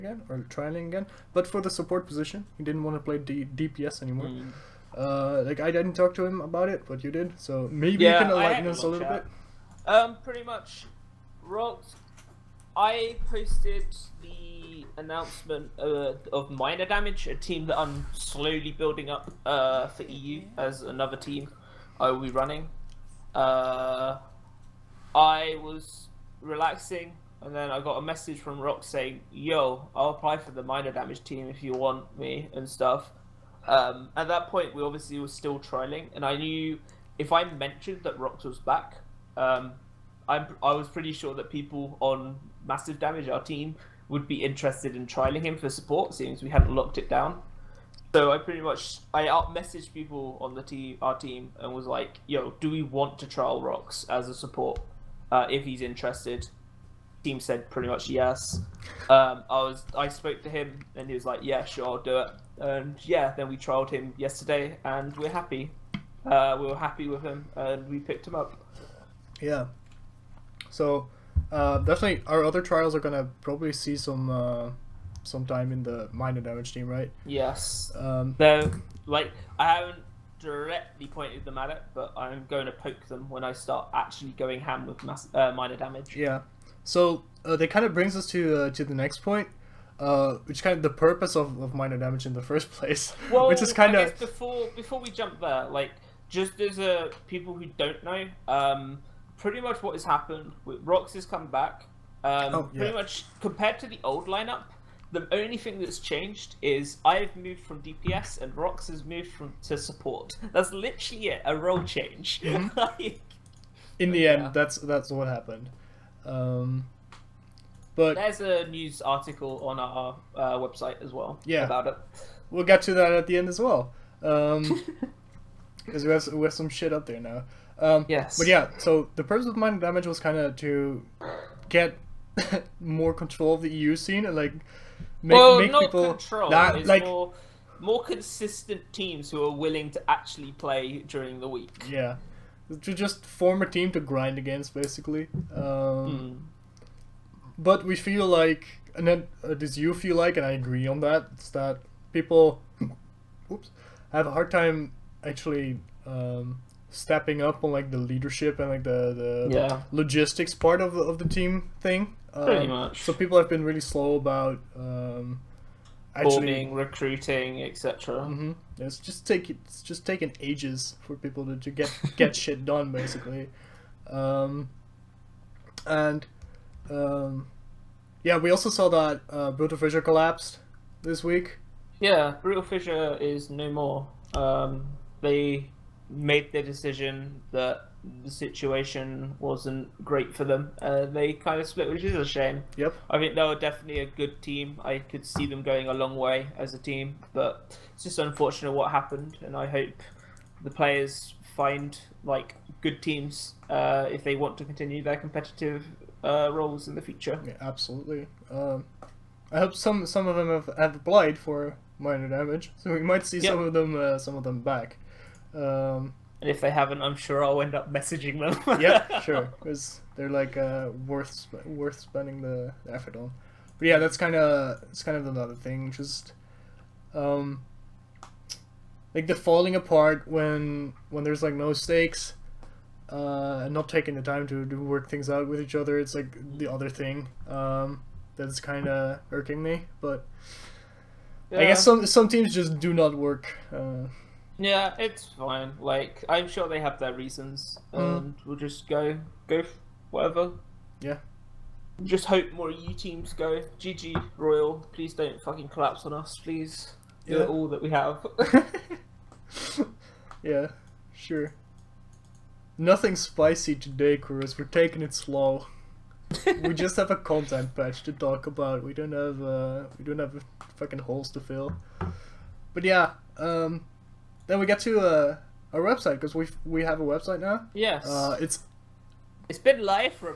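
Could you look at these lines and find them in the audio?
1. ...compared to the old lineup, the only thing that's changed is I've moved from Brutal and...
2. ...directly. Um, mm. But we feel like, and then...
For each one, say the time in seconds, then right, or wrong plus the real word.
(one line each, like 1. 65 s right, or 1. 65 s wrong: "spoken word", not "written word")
1. 103 s wrong: "DPS", not "Brutal"
2. 144 s wrong: "basically", not "directly".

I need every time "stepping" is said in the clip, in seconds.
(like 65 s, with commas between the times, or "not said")
156 s.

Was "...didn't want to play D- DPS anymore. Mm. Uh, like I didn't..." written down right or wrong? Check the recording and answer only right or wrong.
right.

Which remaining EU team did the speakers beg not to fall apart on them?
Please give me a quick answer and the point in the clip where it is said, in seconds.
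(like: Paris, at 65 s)
GG Royal, at 253 s.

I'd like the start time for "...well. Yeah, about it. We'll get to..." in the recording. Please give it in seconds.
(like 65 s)
121 s.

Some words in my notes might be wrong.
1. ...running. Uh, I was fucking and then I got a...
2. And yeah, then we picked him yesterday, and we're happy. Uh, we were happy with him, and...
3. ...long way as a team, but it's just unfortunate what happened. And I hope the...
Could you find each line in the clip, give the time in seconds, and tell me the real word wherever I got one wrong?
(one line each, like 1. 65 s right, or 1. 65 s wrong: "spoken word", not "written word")
1. 22 s wrong: "relaxing", not "fucking"
2. 62 s wrong: "trialed", not "picked"
3. 195 s right.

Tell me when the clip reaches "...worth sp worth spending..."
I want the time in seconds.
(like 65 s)
221 s.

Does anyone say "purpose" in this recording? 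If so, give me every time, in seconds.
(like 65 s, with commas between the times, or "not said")
90 s, 129 s.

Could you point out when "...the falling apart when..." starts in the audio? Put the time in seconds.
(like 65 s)
229 s.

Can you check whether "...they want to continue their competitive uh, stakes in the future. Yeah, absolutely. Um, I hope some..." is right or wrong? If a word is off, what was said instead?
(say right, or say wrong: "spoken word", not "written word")
wrong: "roles", not "stakes".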